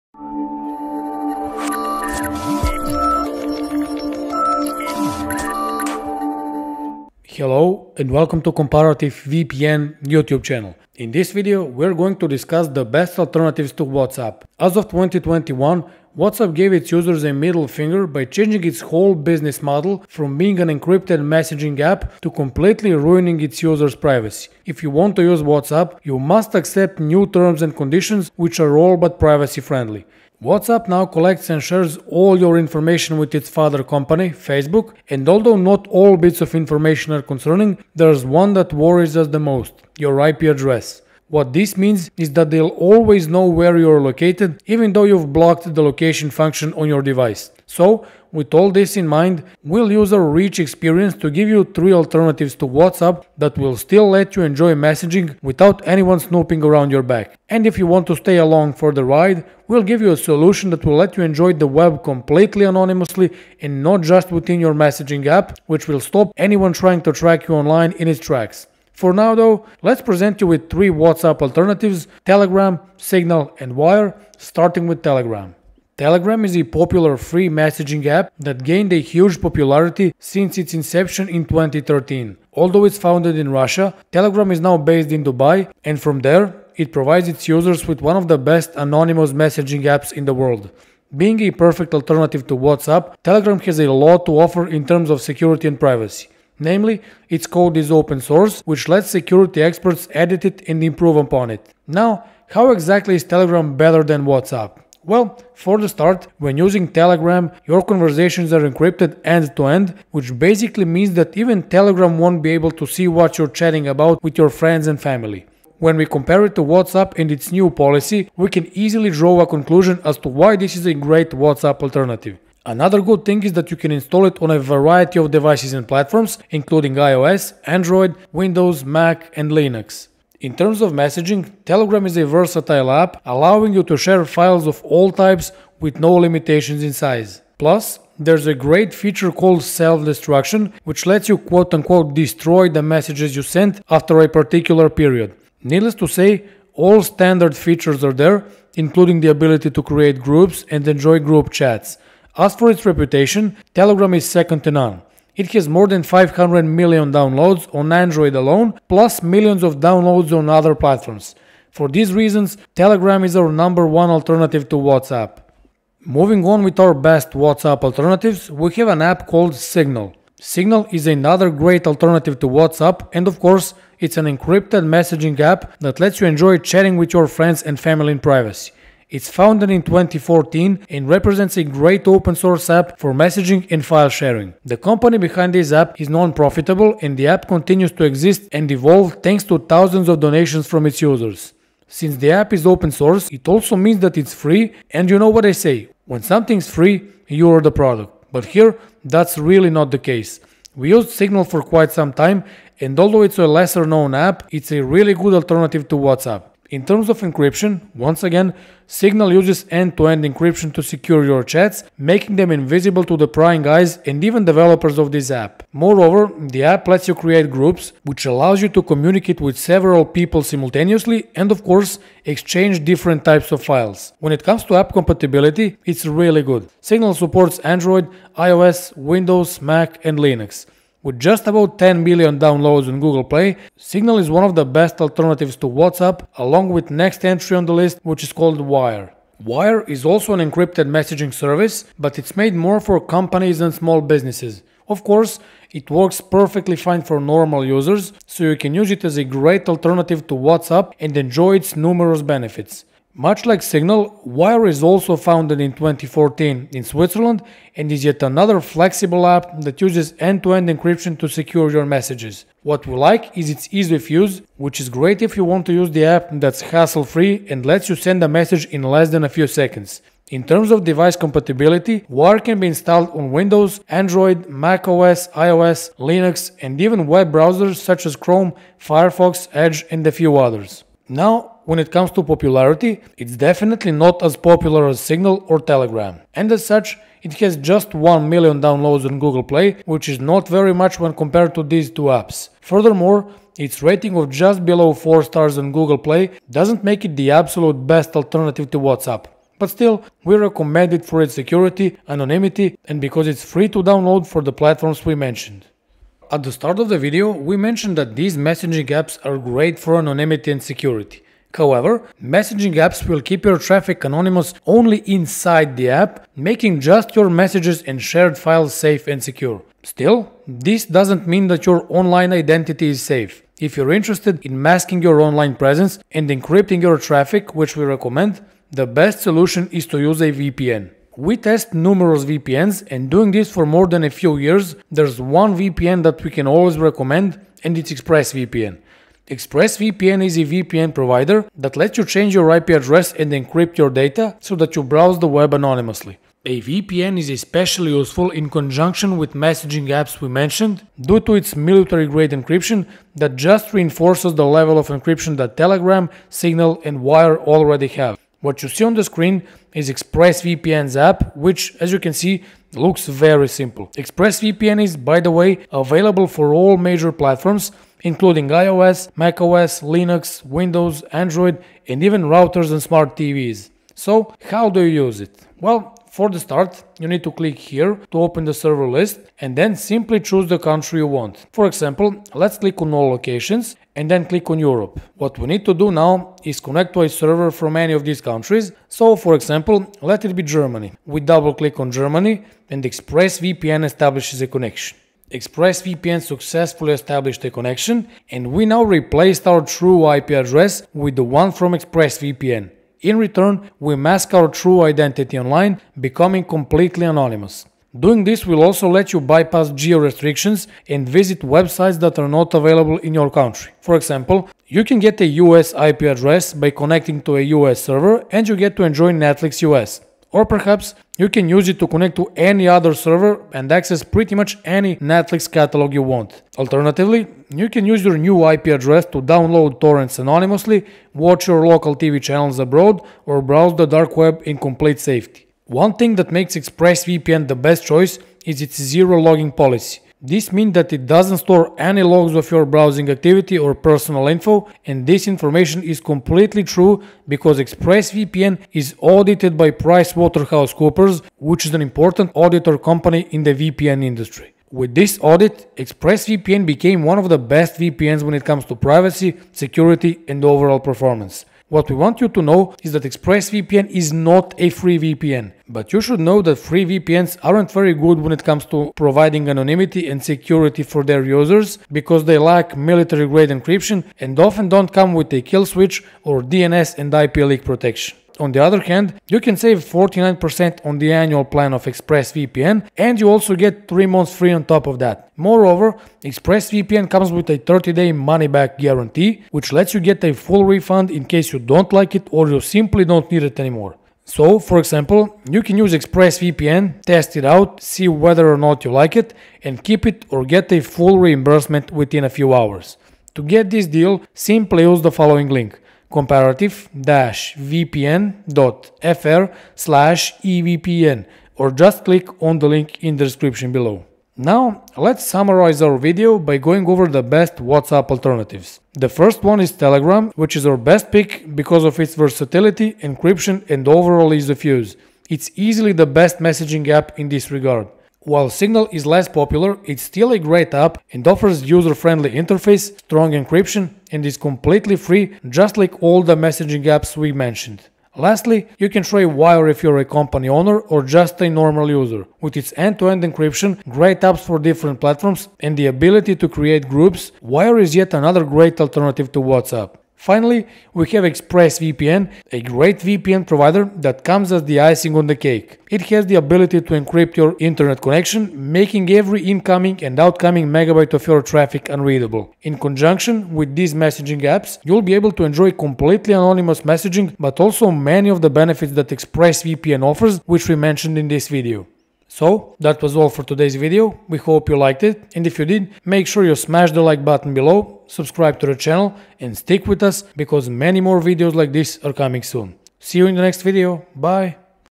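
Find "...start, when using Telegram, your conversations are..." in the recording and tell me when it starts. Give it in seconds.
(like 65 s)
105 s.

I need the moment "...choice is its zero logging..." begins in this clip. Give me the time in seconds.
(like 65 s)
437 s.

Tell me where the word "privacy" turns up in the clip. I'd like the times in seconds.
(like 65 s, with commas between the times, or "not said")
23 s, 29 s, 95 s, 178 s, 458 s.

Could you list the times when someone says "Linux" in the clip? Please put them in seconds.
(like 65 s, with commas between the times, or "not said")
129 s, 230 s, 275 s, 369 s.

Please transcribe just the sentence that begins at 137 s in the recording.
Plus, there's a great feature called self-destruction, which lets you quote-unquote destroy the messages you sent after a particular period.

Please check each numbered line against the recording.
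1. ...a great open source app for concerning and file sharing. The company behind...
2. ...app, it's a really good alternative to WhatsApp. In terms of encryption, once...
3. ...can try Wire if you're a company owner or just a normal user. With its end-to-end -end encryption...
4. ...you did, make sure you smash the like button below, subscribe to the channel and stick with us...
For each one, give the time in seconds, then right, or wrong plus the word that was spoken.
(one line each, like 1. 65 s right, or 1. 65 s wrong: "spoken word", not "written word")
1. 181 s wrong: "messaging", not "concerning"
2. 204 s right
3. 538 s right
4. 575 s right.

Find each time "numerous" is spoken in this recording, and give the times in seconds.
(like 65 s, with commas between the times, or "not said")
251 s, 331 s.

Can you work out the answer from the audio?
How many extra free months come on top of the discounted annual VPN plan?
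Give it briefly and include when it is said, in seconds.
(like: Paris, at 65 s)
3 months, at 483 s.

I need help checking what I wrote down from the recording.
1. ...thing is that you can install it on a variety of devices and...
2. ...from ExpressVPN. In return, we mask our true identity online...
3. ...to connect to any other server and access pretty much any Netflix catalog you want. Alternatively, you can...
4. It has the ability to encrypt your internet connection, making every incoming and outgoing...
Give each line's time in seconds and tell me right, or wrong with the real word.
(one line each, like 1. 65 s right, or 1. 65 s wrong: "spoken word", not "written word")
1. 123 s right
2. 401 s right
3. 421 s right
4. 555 s right.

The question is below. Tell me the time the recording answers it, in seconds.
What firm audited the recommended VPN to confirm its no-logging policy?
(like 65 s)
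449 s.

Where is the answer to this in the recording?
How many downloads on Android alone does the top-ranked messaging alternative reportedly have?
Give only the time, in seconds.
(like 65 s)
155 s.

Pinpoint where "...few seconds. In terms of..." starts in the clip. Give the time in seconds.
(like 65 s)
269 s.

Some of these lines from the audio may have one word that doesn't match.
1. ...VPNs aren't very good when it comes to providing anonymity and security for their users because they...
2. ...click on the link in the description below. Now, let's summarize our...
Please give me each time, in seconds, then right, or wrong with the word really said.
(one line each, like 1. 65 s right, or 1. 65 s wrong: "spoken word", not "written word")
1. 466 s right
2. 512 s right.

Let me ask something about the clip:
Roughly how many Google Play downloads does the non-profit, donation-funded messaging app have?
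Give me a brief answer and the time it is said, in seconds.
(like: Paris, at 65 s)
about 10 million, at 231 s.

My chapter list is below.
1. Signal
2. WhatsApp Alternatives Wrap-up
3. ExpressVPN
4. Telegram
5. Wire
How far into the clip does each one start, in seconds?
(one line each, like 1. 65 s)
1. 165 s
2. 514 s
3. 306 s
4. 75 s
5. 239 s.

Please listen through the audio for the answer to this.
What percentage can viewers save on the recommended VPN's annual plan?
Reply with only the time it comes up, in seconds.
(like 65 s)
479 s.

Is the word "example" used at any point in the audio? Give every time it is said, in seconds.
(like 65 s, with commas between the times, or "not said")
381 s, 389 s, 413 s, 494 s.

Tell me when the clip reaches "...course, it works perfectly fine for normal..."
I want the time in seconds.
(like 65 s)
245 s.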